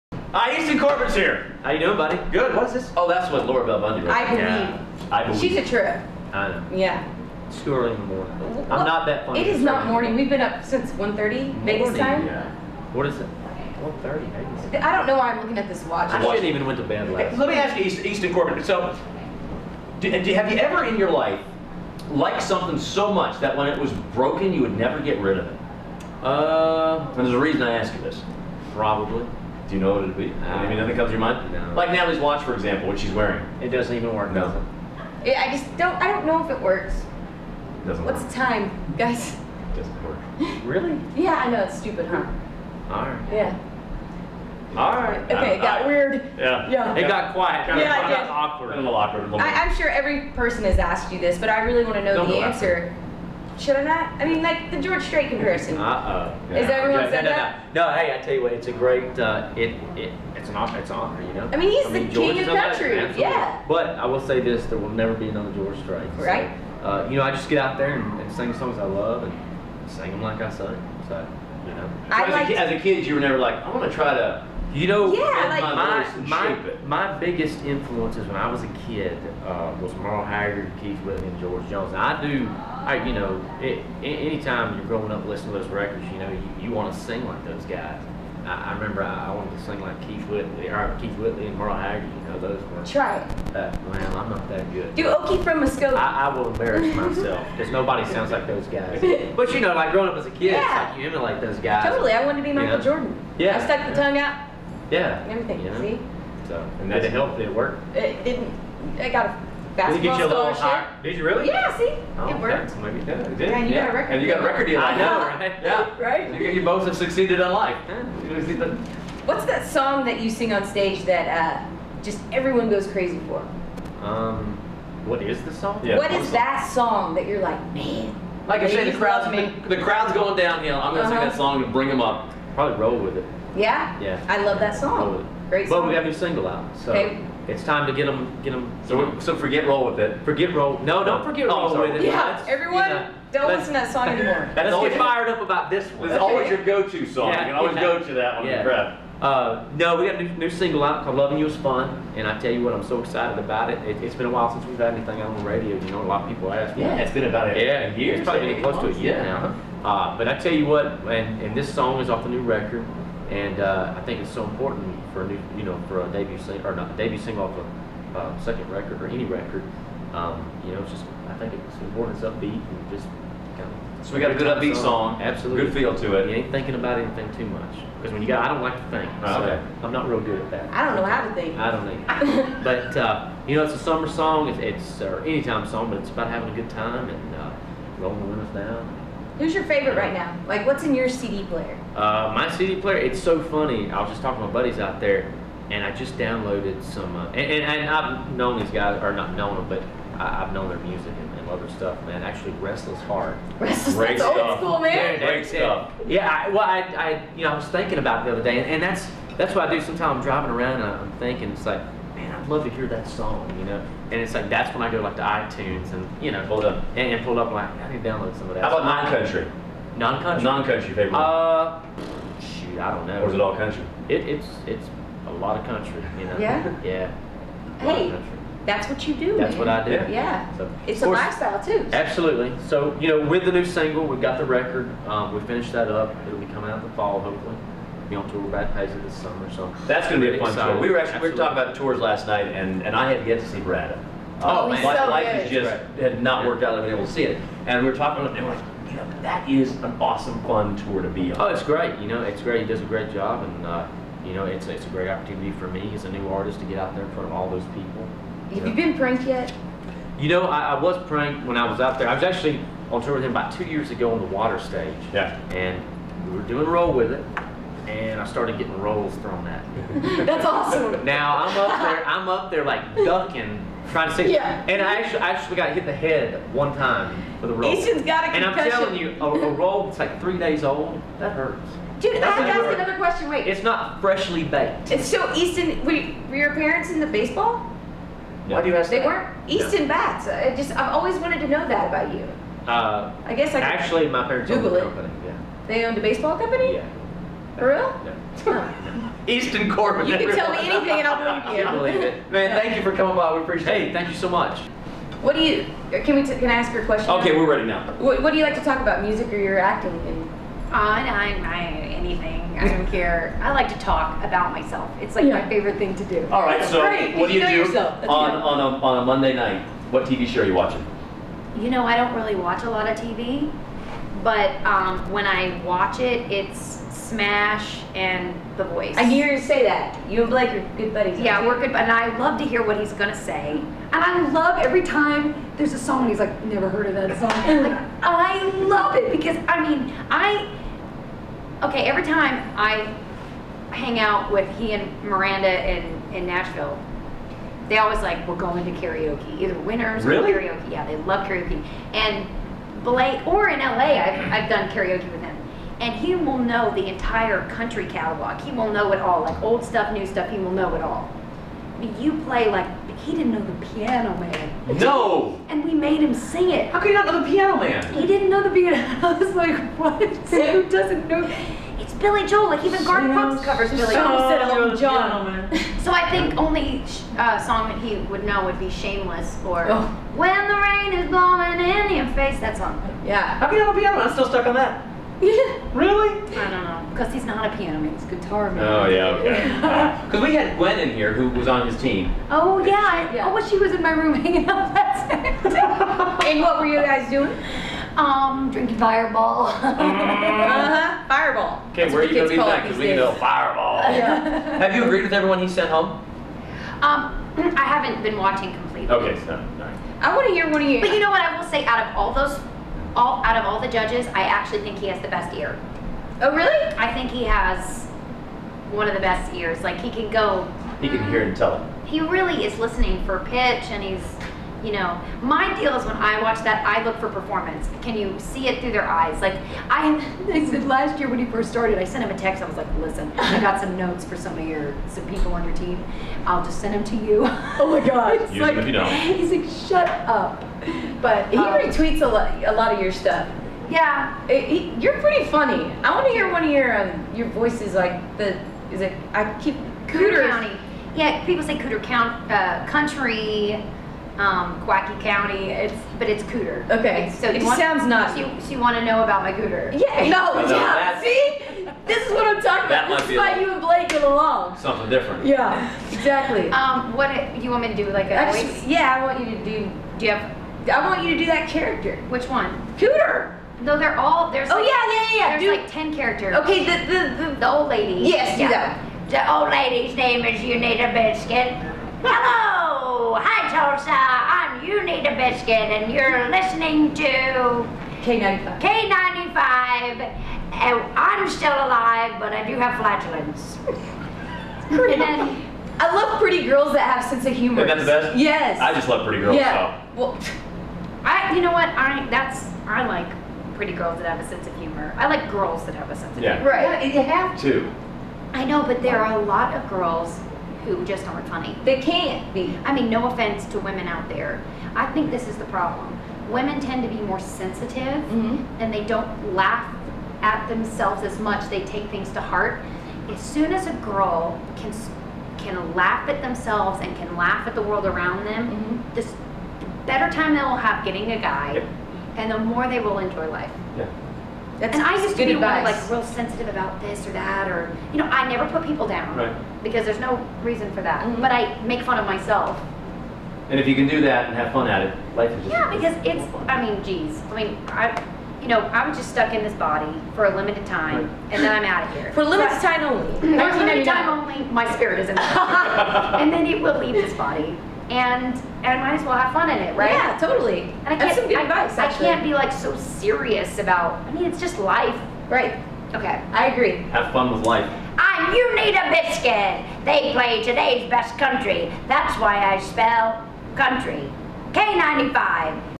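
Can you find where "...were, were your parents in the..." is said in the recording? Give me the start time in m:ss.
4:45.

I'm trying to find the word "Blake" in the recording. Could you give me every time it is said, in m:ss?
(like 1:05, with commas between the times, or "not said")
5:30, 5:52, 7:43.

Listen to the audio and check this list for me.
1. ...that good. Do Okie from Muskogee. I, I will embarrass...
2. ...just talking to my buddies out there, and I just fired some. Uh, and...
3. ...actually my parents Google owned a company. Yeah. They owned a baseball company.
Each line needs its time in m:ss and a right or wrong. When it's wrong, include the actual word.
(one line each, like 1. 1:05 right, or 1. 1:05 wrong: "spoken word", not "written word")
1. 1:34 right
2. 3:14 wrong: "downloaded", not "fired"
3. 4:53 right.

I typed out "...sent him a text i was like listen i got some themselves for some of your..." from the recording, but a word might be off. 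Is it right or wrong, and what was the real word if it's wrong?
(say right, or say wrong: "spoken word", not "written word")
wrong: "notes", not "themselves".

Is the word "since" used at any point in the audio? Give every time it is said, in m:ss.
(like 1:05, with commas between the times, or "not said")
0:10, 2:34.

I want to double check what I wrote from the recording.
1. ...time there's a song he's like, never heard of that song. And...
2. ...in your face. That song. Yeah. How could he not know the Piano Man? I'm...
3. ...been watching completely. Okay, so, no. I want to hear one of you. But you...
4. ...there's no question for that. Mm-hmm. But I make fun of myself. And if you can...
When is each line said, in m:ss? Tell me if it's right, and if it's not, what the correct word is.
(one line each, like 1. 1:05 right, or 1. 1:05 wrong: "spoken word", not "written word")
1. 5:34 right
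2. 6:21 right
3. 6:48 right
4. 8:59 wrong: "reason", not "question".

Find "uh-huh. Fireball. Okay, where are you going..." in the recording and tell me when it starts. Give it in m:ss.
6:39.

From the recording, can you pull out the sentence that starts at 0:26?
Uh, and there's a reason I ask you this.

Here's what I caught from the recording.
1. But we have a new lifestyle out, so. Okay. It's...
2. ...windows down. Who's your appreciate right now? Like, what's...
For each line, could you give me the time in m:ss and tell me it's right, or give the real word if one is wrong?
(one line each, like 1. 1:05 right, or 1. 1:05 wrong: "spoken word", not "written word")
1. 2:15 wrong: "single", not "lifestyle"
2. 3:08 wrong: "favorite", not "appreciate".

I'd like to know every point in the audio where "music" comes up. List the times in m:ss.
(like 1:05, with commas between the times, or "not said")
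3:20, 5:09.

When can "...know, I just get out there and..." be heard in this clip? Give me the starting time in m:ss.
1:07.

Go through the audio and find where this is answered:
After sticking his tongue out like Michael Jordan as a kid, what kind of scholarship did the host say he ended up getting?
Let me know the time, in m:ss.
1:49.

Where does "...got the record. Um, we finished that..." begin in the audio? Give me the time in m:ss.
3:54.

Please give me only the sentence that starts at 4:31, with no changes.
Now I'm up there, I'm up there like ducking, trying to see.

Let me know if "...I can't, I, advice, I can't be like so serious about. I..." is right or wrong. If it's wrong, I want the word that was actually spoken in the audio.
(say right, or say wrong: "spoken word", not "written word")
right.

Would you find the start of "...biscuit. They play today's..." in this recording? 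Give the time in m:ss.
9:28.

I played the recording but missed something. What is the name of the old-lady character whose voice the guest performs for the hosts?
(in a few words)
Unita Biscuit.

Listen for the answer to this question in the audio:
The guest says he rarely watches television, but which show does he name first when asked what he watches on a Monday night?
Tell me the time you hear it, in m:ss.
5:27.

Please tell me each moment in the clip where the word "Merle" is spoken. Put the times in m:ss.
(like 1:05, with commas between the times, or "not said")
1:19, 1:31.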